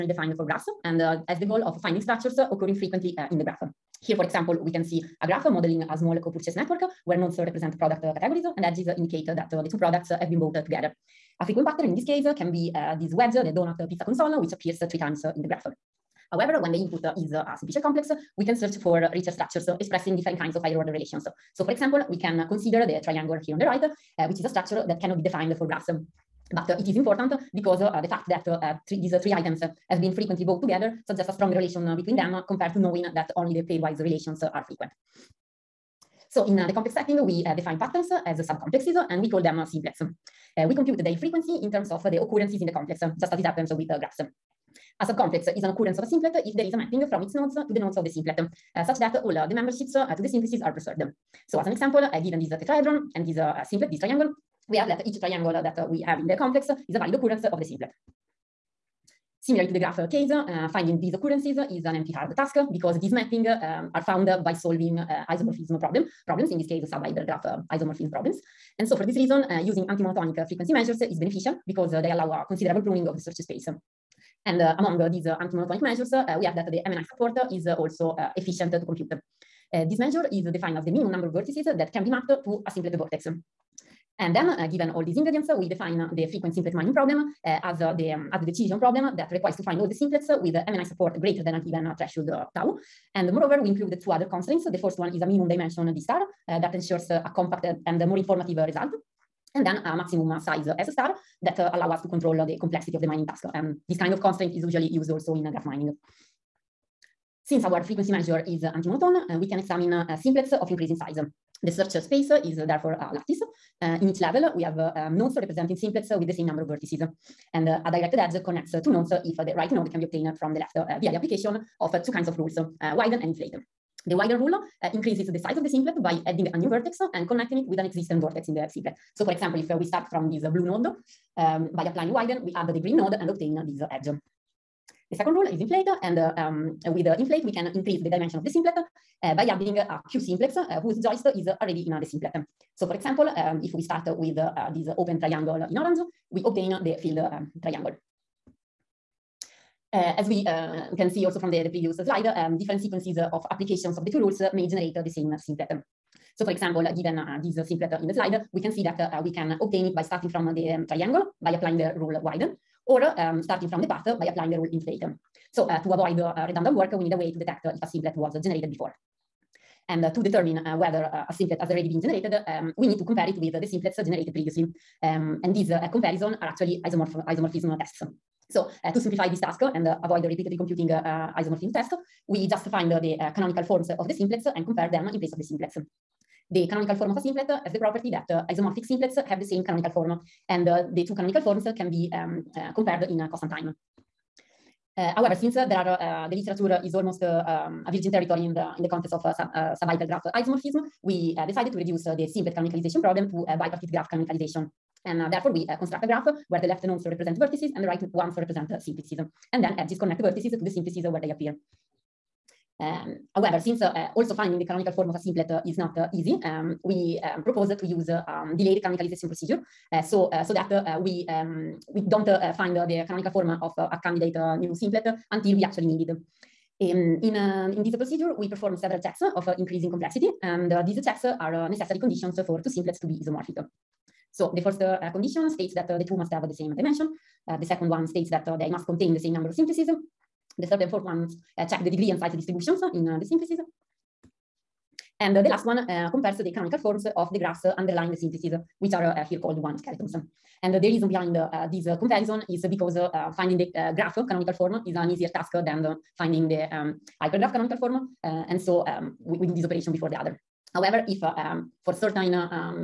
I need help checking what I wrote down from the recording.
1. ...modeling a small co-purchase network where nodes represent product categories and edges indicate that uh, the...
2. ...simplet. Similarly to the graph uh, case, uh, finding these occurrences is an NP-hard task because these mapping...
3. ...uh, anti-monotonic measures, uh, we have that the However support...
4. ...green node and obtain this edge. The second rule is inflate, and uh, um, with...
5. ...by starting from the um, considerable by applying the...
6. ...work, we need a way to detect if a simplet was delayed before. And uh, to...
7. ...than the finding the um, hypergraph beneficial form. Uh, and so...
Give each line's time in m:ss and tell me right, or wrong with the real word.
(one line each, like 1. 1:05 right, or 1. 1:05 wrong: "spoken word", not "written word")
1. 0:05 right
2. 0:57 right
3. 1:15 wrong: "MNI", not "However"
4. 2:12 right
5. 2:39 wrong: "triangle", not "considerable"
6. 2:46 wrong: "generated", not "delayed"
7. 4:15 wrong: "canonical", not "beneficial".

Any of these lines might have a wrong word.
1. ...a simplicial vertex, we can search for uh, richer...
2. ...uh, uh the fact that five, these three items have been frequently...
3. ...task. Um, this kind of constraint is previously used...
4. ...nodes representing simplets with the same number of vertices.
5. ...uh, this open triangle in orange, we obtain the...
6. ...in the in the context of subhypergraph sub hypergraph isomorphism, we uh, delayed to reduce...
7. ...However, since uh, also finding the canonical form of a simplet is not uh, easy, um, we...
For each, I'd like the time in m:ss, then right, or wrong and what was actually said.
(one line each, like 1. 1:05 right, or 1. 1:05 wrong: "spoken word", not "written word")
1. 0:17 wrong: "complex", not "vertex"
2. 0:27 wrong: "three", not "five"
3. 1:43 wrong: "usually", not "previously"
4. 1:55 right
5. 2:24 right
6. 3:18 wrong: "decided", not "delayed"
7. 3:33 right.